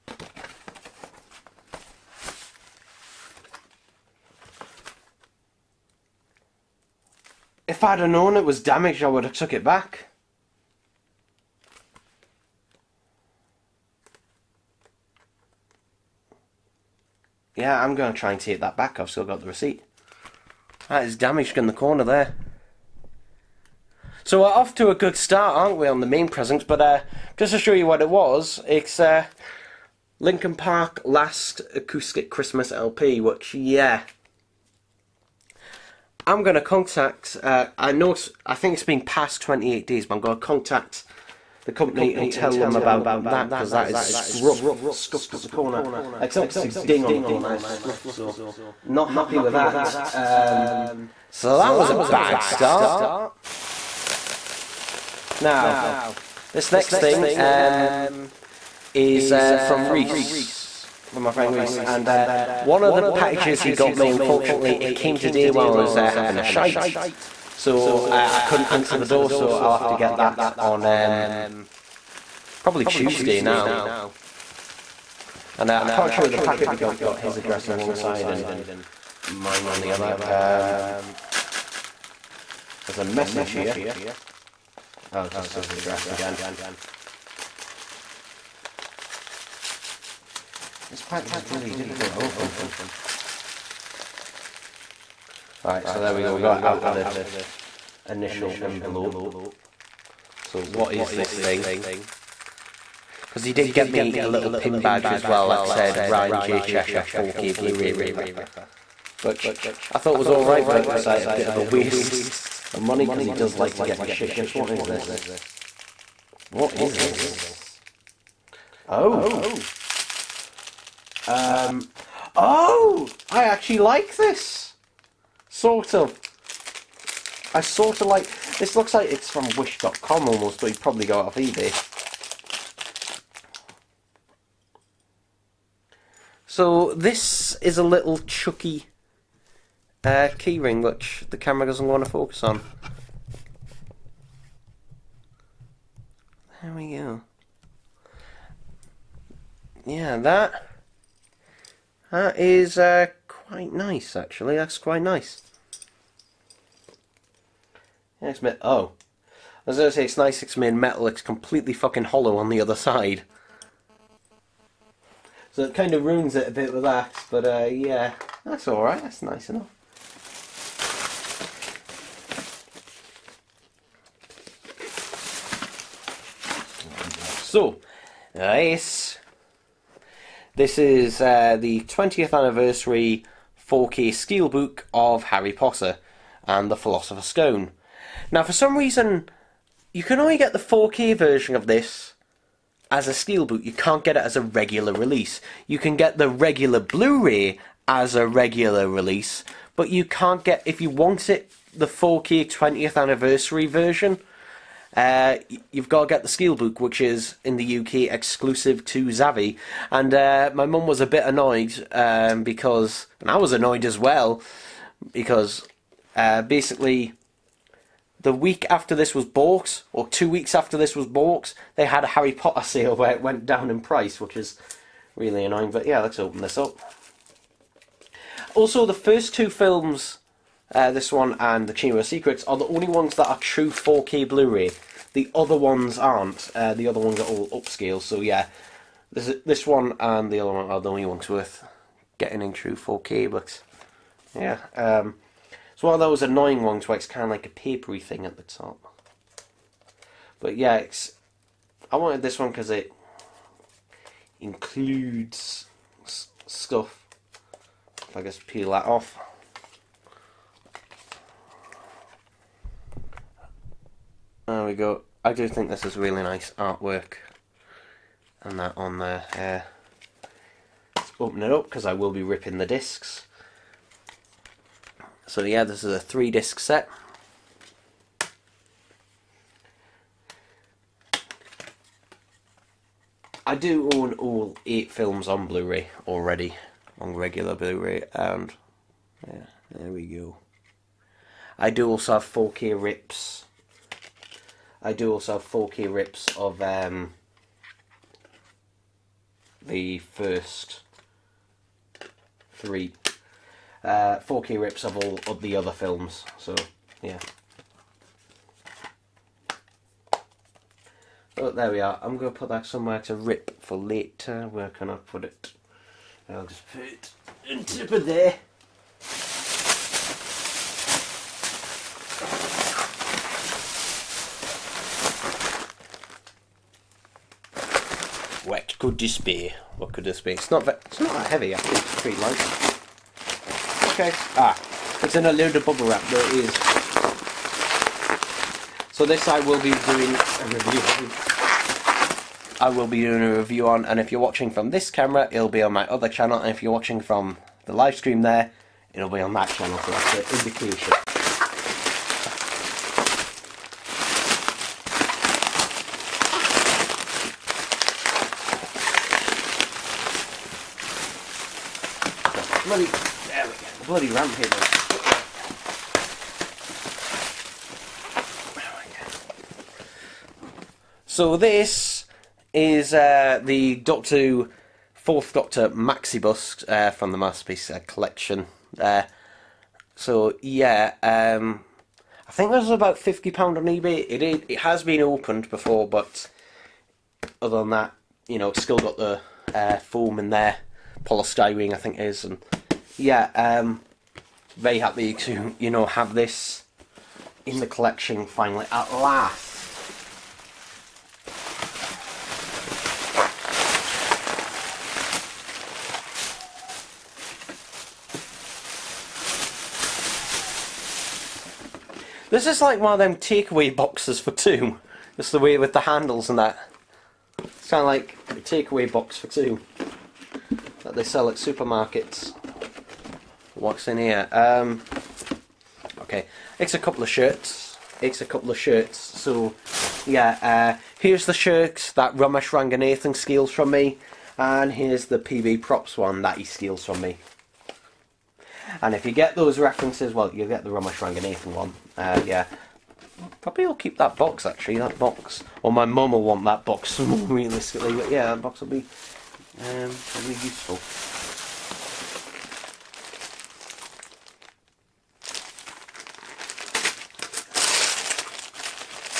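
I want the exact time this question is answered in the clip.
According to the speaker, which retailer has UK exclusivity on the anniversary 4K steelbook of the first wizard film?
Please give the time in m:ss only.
3:29.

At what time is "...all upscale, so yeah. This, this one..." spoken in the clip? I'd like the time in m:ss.
3:57.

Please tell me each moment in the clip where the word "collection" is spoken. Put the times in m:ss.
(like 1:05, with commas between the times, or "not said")
6:17, 6:37.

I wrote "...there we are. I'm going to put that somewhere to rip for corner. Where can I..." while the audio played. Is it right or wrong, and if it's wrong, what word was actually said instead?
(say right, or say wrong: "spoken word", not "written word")
wrong: "later", not "corner".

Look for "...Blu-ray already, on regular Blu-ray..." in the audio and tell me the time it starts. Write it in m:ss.
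4:45.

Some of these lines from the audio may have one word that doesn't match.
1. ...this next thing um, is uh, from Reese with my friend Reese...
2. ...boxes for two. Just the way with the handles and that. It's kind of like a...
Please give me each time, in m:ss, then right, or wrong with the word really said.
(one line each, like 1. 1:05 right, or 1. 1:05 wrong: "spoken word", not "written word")
1. 0:56 right
2. 6:53 right.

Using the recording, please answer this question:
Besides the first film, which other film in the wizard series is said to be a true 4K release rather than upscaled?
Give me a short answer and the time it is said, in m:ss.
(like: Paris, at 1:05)
The Chamber of Secrets, at 3:51.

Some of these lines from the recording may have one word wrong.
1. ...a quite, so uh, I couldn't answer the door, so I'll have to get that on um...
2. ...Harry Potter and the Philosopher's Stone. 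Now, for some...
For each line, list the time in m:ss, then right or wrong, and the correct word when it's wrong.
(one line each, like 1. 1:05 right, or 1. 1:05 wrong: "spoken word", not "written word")
1. 1:06 wrong: "shite", not "quite"
2. 3:05 right.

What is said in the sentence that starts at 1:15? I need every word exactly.
And uh, I can't show you the packet because it's got his address on one side and mine on the other.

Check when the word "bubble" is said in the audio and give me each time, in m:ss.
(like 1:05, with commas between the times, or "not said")
5:35.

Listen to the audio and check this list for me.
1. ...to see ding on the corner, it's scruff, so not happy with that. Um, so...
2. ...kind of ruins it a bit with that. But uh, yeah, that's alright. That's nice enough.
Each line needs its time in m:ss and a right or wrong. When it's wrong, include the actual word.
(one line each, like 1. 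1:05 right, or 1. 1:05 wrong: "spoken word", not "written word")
1. 0:46 right
2. 2:45 right.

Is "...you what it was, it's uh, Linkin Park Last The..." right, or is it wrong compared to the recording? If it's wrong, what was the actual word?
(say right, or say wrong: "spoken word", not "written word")
wrong: "Acoustic", not "The".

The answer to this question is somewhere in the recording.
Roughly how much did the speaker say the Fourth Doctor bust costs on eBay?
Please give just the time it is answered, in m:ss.
6:22.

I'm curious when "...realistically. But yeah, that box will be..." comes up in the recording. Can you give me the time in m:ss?
7:27.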